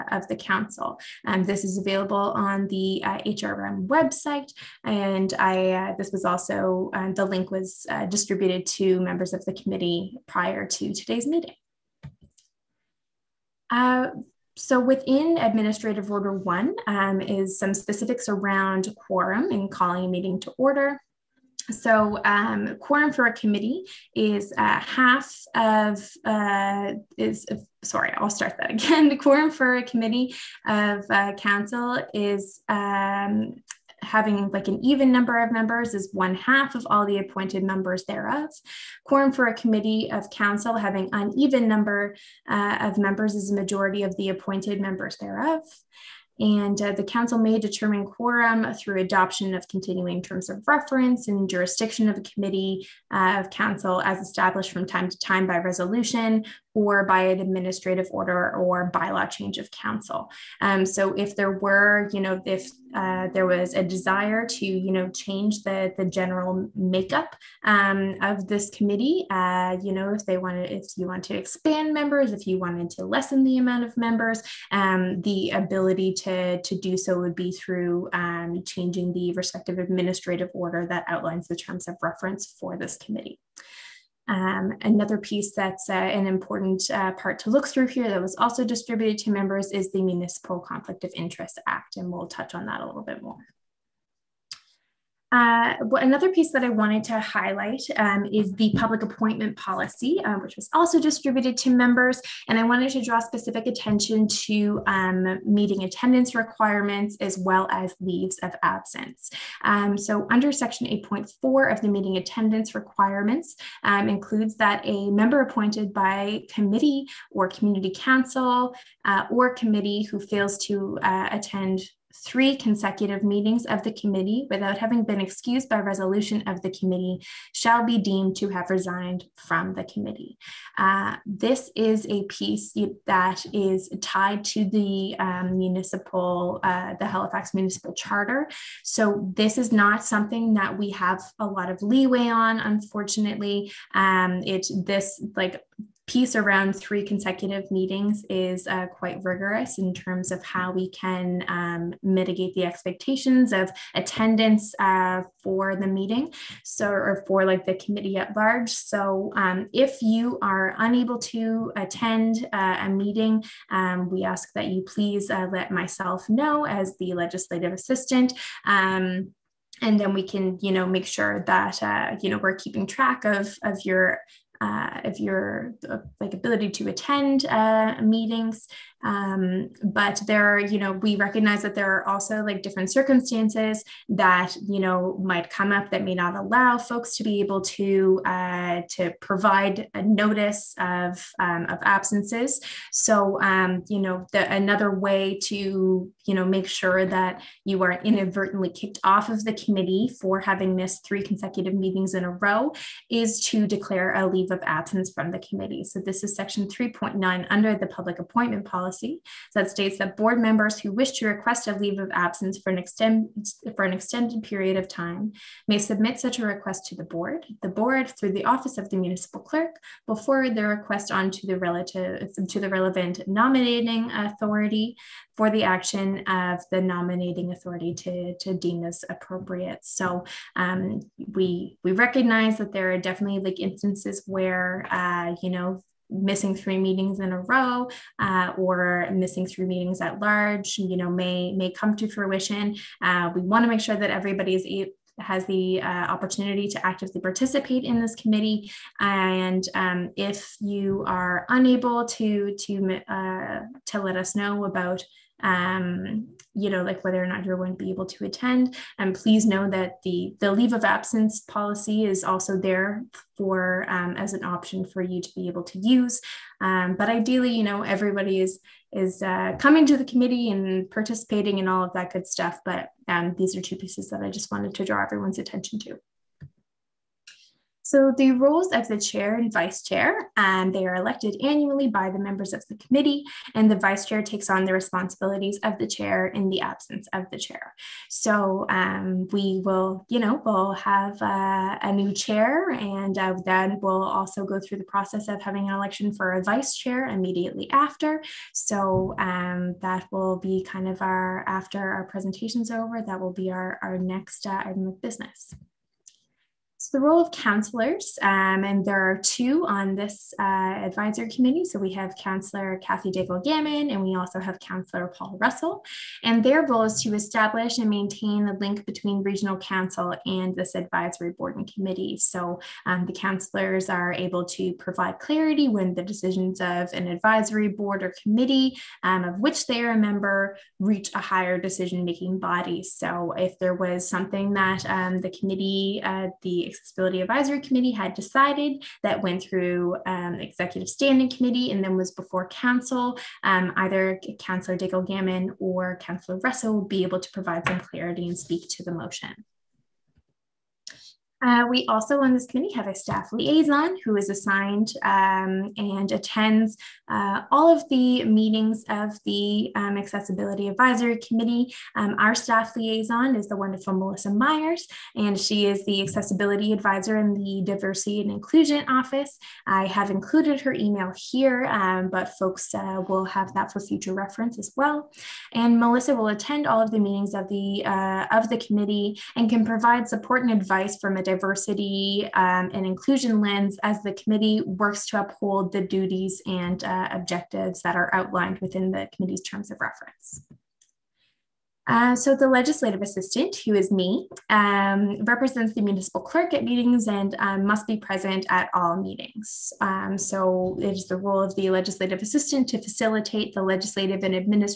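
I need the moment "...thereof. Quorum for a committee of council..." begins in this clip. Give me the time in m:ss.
0:38.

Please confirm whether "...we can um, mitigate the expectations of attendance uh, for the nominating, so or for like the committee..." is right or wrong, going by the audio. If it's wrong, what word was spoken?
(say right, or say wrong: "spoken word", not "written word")
wrong: "meeting", not "nominating".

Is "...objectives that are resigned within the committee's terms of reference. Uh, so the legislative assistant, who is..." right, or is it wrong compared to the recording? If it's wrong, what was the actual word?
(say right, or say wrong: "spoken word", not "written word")
wrong: "outlined", not "resigned".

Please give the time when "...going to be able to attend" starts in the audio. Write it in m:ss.
4:17.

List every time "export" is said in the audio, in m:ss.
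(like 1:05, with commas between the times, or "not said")
not said.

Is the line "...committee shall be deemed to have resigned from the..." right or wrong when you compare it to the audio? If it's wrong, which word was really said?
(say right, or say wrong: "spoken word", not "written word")
right.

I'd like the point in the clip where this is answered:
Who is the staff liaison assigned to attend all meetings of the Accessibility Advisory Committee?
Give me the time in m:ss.
6:03.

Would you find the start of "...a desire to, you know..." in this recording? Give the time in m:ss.
1:03.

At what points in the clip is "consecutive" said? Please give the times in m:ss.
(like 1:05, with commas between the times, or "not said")
2:02, 2:27, 3:21.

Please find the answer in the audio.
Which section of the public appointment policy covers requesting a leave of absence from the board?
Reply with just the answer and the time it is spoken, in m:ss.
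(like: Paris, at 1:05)
section 3.9, at 3:26.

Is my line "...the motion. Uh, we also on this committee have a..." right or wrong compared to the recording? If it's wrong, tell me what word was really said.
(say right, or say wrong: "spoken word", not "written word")
right.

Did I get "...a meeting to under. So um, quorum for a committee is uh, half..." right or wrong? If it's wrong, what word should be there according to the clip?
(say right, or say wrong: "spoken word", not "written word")
wrong: "order", not "under".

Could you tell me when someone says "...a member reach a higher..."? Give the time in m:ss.
5:29.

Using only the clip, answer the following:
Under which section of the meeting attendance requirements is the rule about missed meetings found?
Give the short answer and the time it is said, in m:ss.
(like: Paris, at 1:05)
section 8.4, at 1:50.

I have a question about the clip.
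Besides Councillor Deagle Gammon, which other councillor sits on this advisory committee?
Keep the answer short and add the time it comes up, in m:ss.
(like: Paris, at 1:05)
Paul Russell, at 5:15.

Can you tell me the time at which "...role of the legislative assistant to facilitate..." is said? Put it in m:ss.
6:41.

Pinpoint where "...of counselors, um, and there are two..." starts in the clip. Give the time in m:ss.
5:07.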